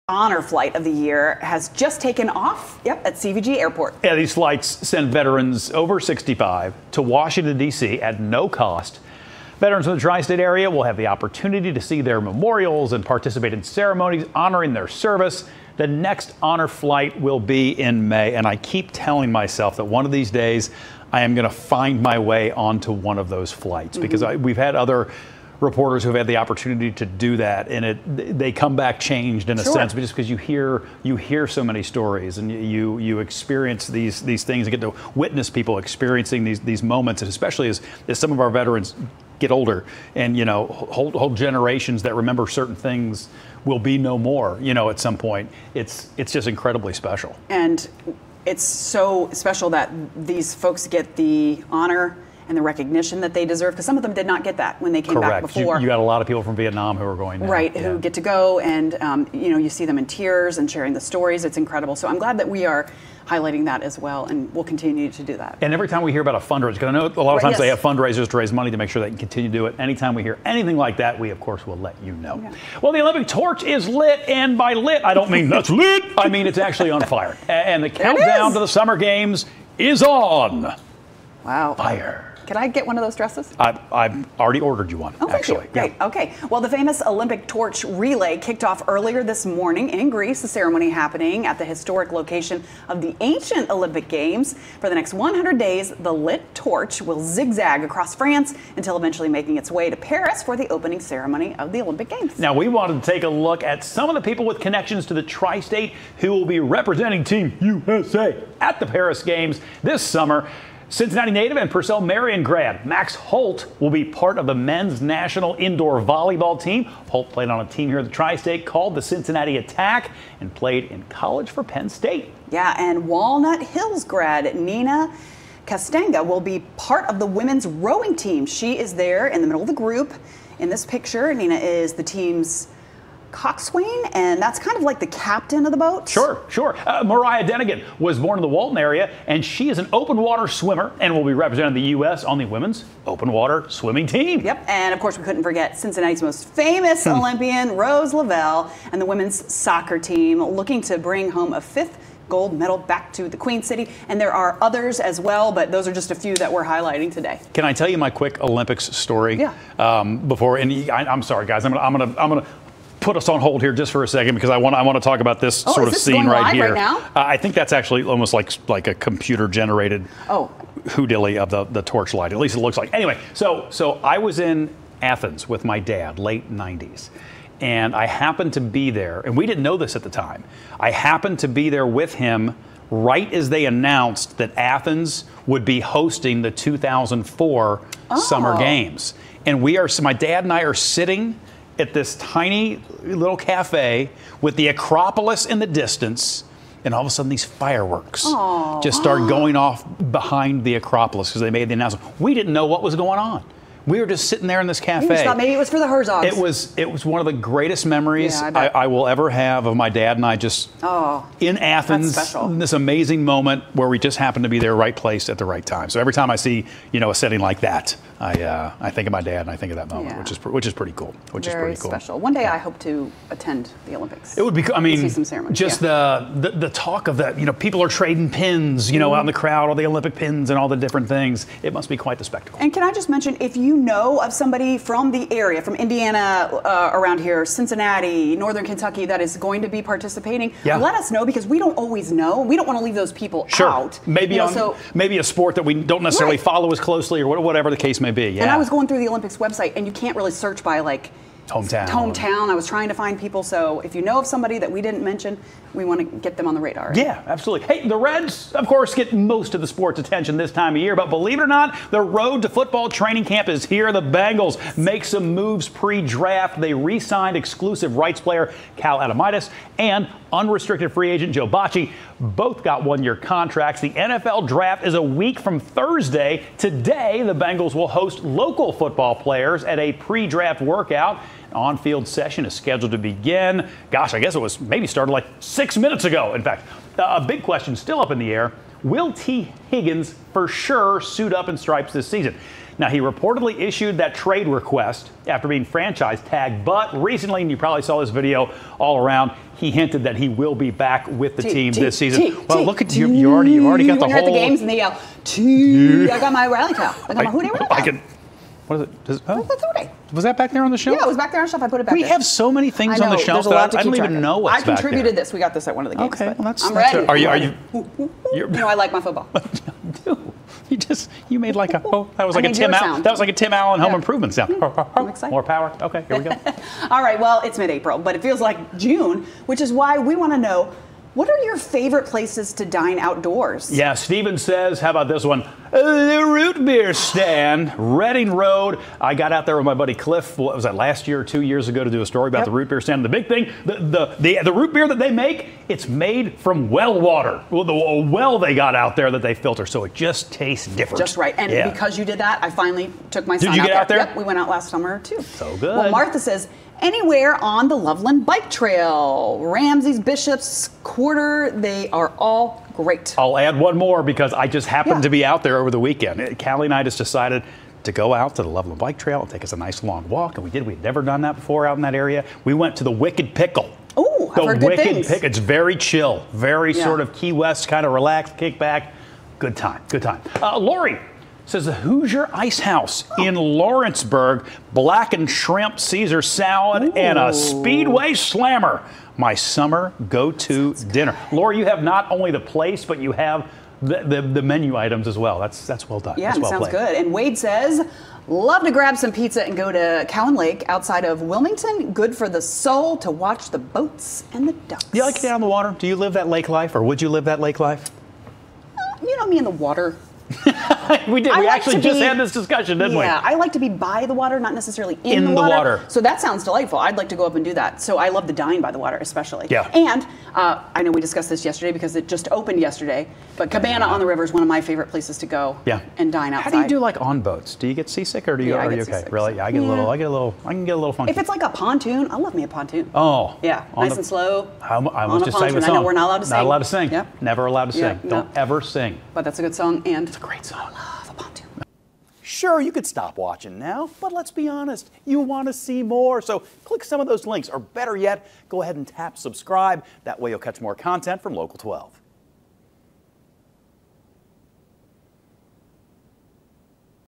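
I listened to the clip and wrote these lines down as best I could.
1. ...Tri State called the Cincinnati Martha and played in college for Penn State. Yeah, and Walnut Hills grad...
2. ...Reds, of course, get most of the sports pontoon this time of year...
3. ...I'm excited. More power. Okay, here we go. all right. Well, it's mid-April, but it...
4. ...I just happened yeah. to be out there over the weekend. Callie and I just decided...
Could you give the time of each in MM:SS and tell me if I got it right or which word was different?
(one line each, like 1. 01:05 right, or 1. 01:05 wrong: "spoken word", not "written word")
1. 01:58 wrong: "Attack", not "Martha"
2. 04:17 wrong: "attention", not "pontoon"
3. 05:24 right
4. 06:04 right.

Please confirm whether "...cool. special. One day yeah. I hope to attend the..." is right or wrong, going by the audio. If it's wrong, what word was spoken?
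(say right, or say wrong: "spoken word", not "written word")
right.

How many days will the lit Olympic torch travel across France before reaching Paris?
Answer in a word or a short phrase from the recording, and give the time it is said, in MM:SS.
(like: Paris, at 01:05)
100, at 01:35.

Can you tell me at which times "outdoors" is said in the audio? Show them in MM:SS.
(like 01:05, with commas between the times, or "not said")
05:32.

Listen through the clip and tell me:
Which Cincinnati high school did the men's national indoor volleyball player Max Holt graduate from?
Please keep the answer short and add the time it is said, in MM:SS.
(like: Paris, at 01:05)
Purcell Marian, at 01:51.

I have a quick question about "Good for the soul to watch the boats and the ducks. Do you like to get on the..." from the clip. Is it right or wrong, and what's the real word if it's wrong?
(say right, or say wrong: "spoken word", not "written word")
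right.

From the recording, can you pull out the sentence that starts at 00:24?
because I, we've had other reporters who've had the opportunity to do that, and it they come back changed in a sure.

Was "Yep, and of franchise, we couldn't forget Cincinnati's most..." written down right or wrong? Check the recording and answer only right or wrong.
wrong.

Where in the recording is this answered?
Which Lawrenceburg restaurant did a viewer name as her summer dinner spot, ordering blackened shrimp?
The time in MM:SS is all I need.
06:21.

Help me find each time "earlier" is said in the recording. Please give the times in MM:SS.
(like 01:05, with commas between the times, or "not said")
01:28.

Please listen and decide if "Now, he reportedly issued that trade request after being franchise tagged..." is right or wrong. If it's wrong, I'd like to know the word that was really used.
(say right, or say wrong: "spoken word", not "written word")
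right.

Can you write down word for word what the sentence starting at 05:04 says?
you heard the games and they yell, T.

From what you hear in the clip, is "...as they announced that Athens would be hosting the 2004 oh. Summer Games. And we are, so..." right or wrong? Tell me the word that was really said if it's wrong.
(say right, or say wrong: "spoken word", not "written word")
right.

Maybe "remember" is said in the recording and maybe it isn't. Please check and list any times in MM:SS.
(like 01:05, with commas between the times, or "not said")
00:42.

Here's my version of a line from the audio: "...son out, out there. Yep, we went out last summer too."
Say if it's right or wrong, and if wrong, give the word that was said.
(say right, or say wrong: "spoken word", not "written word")
right.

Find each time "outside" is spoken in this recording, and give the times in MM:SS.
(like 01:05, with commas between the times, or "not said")
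06:40, 07:06.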